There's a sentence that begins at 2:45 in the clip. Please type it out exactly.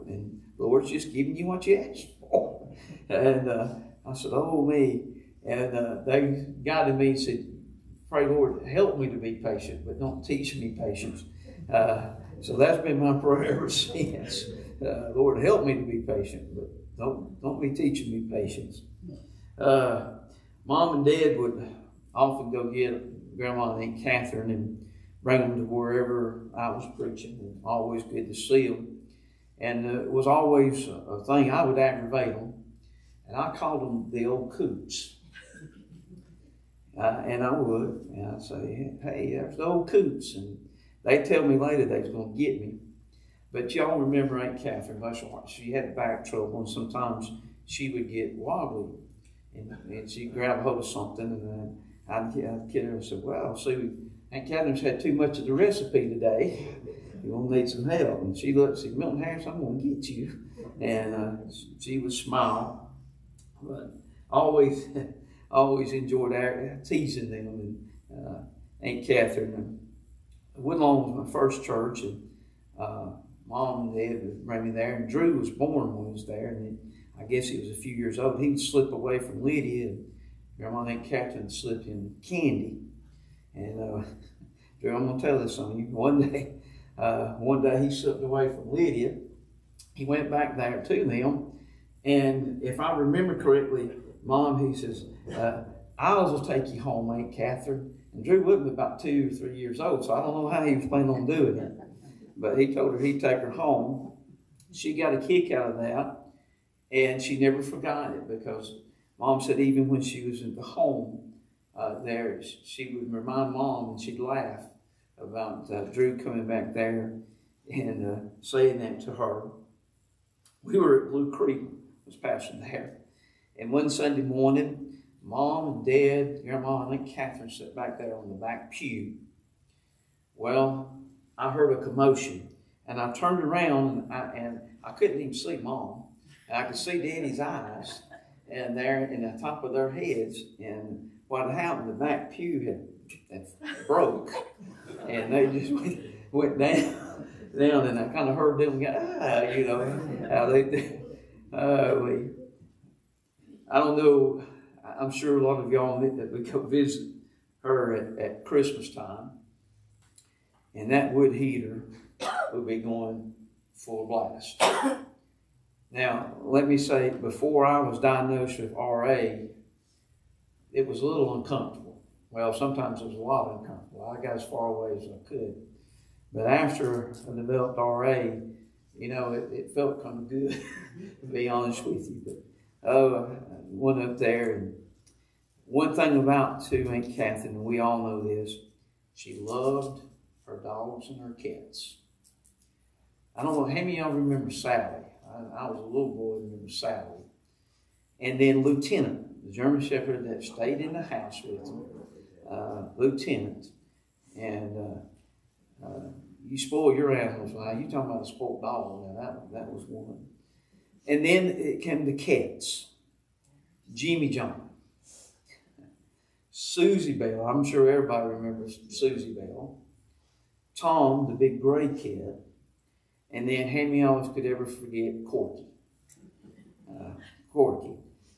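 Now, let me say, before I was diagnosed with RA, it was a little uncomfortable.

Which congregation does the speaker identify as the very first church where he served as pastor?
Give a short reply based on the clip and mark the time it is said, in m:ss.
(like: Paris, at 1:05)
Woodlawn, at 1:10.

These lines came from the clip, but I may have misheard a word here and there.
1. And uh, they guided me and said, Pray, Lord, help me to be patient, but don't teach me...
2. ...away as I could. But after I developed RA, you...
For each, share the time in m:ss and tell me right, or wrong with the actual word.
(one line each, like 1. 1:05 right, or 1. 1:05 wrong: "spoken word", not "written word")
1. 0:05 right
2. 2:54 right.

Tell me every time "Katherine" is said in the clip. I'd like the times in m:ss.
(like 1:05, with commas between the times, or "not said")
0:24, 0:44, 0:54, 1:21, 1:37, 2:07, 3:07.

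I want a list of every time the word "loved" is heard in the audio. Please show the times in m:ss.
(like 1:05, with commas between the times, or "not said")
3:09.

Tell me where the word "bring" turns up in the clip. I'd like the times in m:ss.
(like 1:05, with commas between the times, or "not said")
0:25, 1:14.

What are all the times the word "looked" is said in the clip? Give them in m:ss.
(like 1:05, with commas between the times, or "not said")
0:58.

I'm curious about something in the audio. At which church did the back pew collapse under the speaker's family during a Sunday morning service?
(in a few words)
Blue Creek.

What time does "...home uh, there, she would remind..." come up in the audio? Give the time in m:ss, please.
1:50.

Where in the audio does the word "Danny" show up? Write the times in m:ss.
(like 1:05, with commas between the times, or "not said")
2:16.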